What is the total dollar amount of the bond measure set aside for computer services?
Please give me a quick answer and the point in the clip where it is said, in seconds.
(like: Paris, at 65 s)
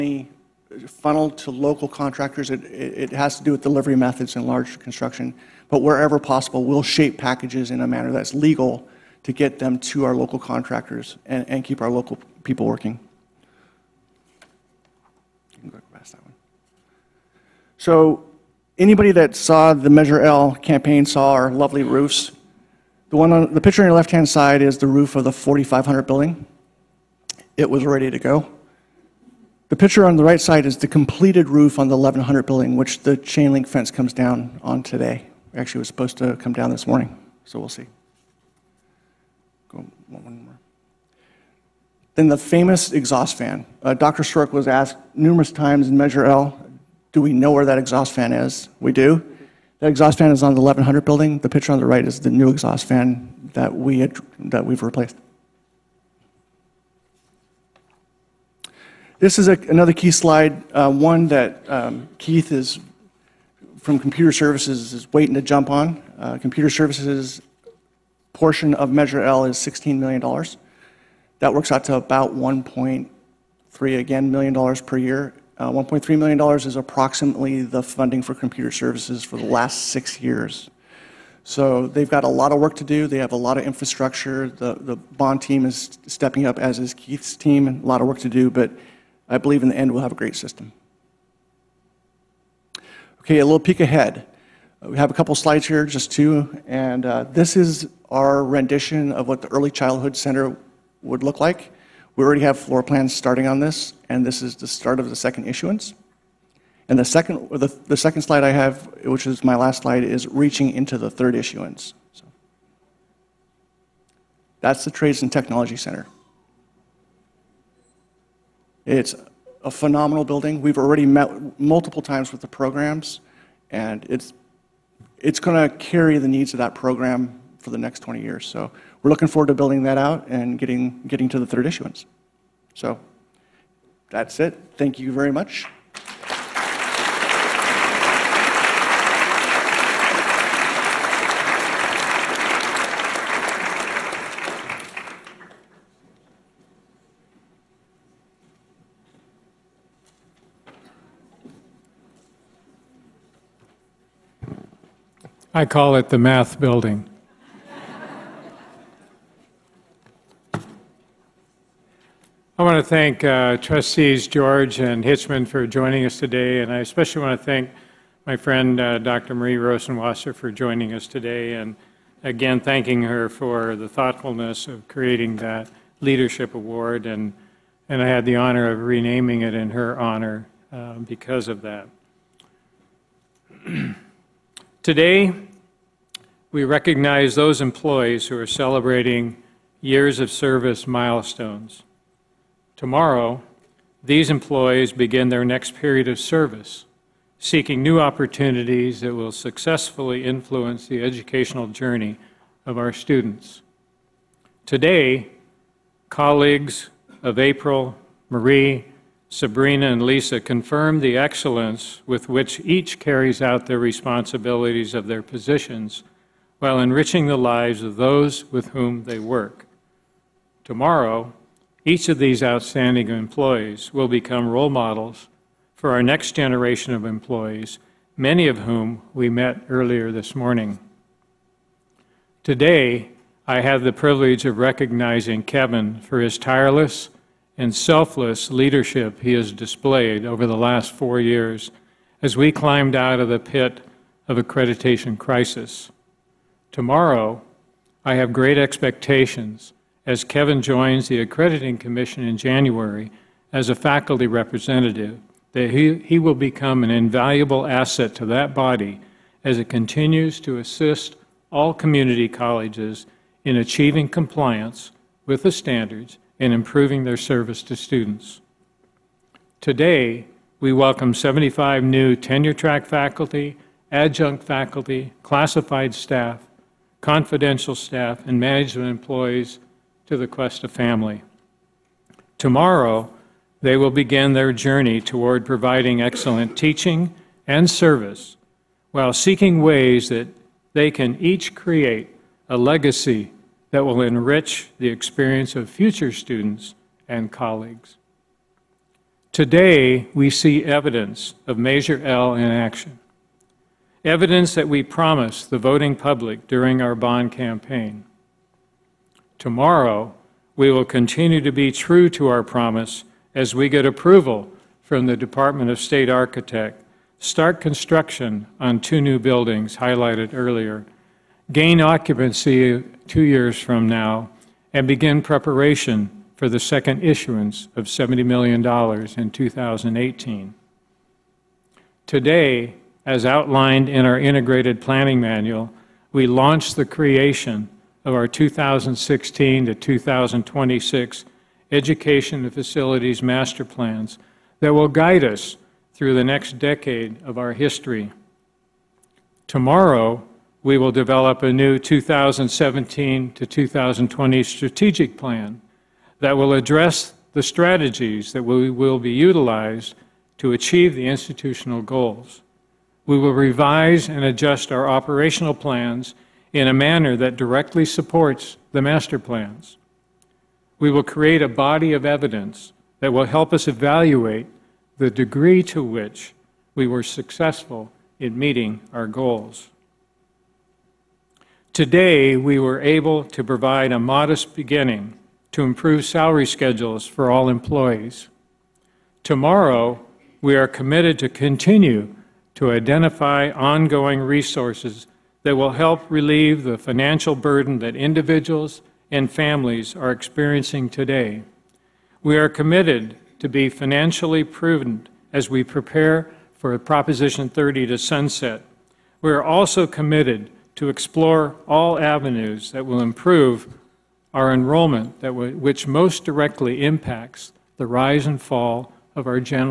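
$16 million, at 69 s.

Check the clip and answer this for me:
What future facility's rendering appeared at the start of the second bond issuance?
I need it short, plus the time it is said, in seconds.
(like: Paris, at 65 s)
Early Childhood Center, at 99 s.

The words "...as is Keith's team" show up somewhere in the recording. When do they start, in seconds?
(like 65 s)
86 s.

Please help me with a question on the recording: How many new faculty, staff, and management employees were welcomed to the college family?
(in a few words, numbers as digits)
75.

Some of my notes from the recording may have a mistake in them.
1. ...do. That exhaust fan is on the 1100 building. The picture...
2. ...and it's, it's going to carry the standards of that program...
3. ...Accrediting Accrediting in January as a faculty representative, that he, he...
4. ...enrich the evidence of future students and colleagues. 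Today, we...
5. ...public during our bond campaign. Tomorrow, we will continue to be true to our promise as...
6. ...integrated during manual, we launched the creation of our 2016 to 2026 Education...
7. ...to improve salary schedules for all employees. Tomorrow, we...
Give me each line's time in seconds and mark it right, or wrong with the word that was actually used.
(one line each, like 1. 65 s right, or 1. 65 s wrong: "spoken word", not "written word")
1. 48 s right
2. 123 s wrong: "needs", not "standards"
3. 251 s wrong: "Commission", not "Accrediting"
4. 294 s wrong: "experience", not "evidence"
5. 305 s right
6. 334 s wrong: "planning", not "during"
7. 385 s right.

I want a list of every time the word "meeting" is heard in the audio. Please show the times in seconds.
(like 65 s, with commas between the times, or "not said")
378 s.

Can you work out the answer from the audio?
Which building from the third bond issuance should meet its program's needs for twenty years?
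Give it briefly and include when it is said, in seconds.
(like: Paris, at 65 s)
Trades and Technology Center, at 114 s.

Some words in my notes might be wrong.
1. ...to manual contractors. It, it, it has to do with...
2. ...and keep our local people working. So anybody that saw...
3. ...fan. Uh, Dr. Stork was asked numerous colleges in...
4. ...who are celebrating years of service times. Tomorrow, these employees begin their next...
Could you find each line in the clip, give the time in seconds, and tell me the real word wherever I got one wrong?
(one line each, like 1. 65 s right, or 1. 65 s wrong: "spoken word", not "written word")
1. 1 s wrong: "local", not "manual"
2. 11 s right
3. 43 s wrong: "times", not "colleges"
4. 188 s wrong: "milestones", not "times".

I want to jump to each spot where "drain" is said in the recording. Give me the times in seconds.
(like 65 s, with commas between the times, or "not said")
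not said.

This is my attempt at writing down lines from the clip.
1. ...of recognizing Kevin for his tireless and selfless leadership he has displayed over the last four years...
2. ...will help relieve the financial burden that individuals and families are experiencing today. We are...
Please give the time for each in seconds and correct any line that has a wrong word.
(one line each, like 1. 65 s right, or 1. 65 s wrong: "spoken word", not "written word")
1. 234 s right
2. 395 s right.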